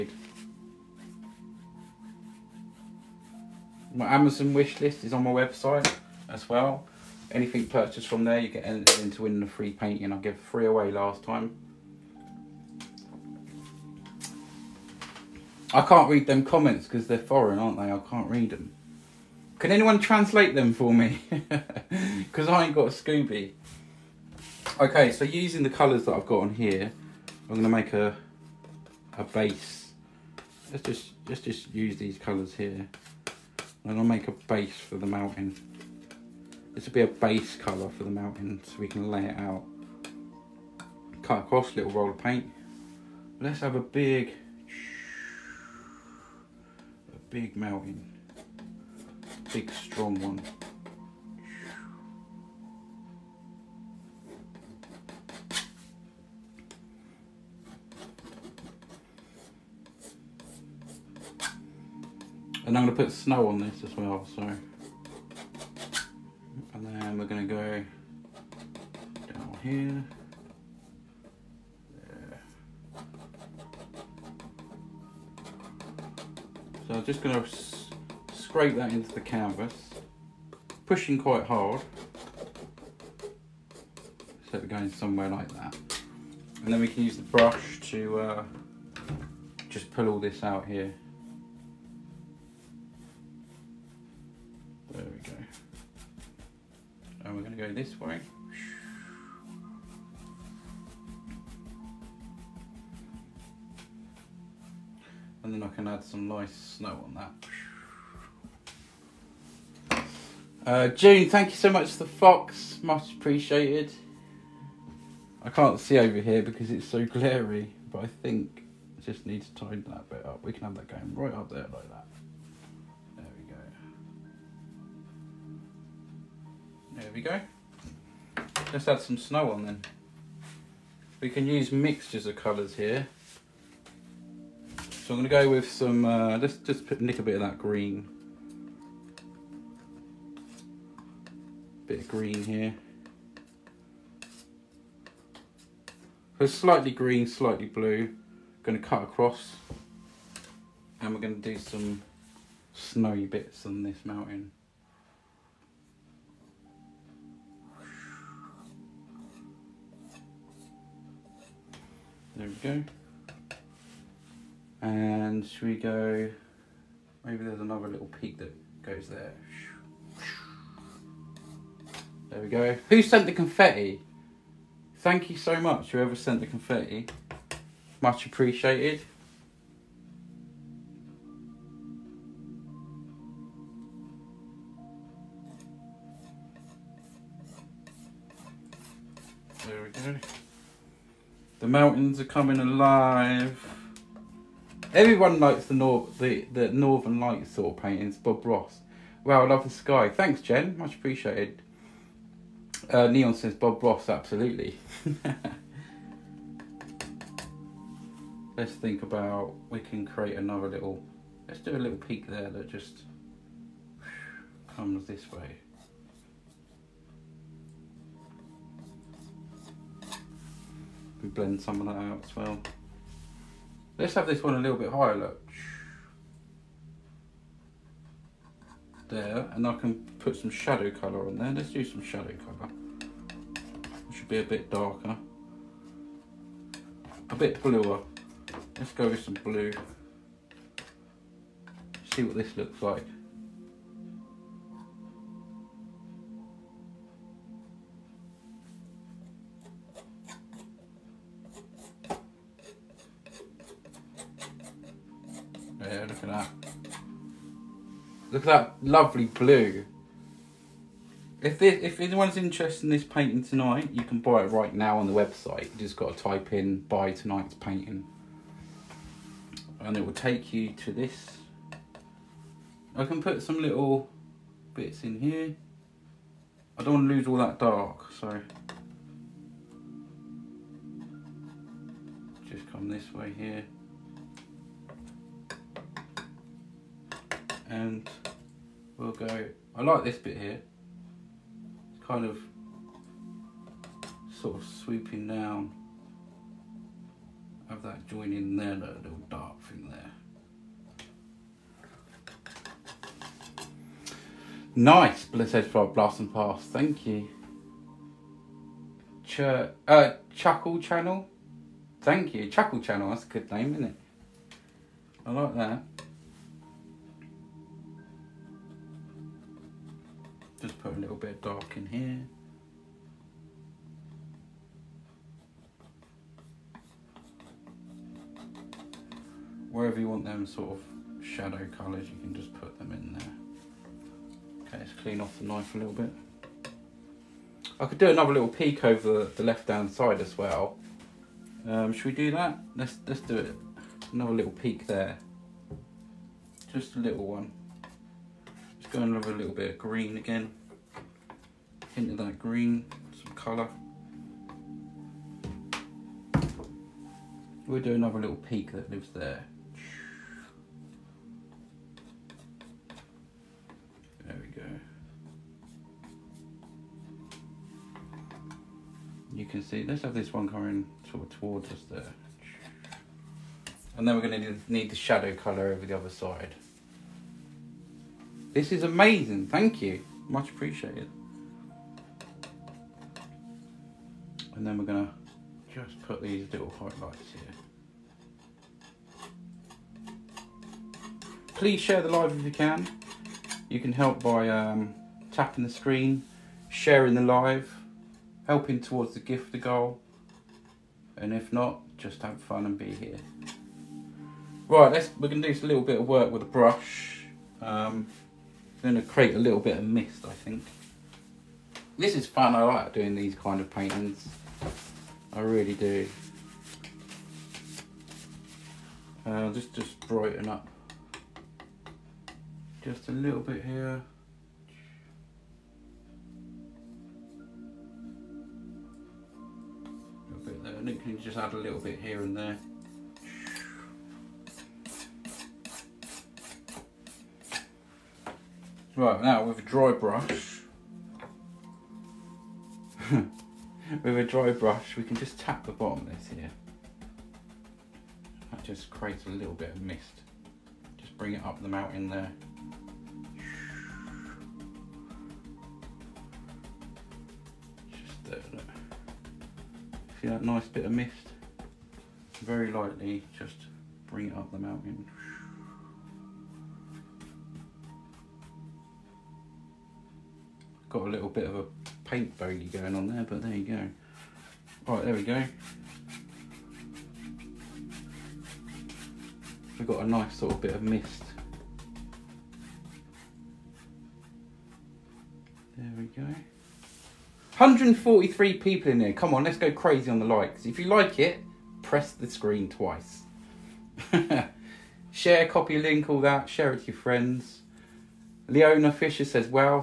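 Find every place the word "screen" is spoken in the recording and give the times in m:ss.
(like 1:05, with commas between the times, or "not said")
6:35, 8:12.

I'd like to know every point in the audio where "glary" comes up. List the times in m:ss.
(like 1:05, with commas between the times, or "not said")
1:57.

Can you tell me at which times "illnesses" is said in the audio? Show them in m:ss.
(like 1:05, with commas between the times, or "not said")
not said.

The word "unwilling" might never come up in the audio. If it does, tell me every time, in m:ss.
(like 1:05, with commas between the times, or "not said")
not said.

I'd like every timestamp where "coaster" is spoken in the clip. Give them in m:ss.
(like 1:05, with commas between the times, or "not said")
not said.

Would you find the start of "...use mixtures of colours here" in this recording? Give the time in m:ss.
2:11.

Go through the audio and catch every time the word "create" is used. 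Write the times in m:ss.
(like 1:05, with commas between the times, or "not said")
3:30, 6:49, 7:28.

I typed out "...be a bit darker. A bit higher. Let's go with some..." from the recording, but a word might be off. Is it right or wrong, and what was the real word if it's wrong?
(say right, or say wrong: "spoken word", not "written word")
wrong: "bluer", not "higher".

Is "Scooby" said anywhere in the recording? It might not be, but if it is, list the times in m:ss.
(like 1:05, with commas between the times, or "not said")
0:22.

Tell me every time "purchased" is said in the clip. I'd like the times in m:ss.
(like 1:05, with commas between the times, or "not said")
0:07.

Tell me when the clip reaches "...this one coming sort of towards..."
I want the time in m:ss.
6:10.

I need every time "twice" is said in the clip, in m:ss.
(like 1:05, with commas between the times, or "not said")
8:12.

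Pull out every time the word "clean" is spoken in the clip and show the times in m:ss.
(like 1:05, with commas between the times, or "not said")
5:35.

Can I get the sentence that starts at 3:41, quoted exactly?
We blend some of that out as well.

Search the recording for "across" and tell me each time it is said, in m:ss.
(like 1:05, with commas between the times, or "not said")
0:41, 2:29.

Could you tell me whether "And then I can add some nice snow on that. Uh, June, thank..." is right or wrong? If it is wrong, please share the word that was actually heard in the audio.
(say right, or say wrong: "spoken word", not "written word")
right.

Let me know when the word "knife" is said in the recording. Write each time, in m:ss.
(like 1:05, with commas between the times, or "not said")
5:35.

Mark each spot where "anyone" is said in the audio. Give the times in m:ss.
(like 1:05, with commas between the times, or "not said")
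0:19, 4:22.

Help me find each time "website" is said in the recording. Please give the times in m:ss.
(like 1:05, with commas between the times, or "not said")
0:05, 4:25.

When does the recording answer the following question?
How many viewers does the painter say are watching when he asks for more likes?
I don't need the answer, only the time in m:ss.
8:06.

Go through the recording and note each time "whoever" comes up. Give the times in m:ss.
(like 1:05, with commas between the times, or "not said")
2:55.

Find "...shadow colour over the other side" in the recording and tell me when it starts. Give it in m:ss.
6:14.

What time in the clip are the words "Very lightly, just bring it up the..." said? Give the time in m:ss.
7:42.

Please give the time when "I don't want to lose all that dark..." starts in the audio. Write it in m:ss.
4:36.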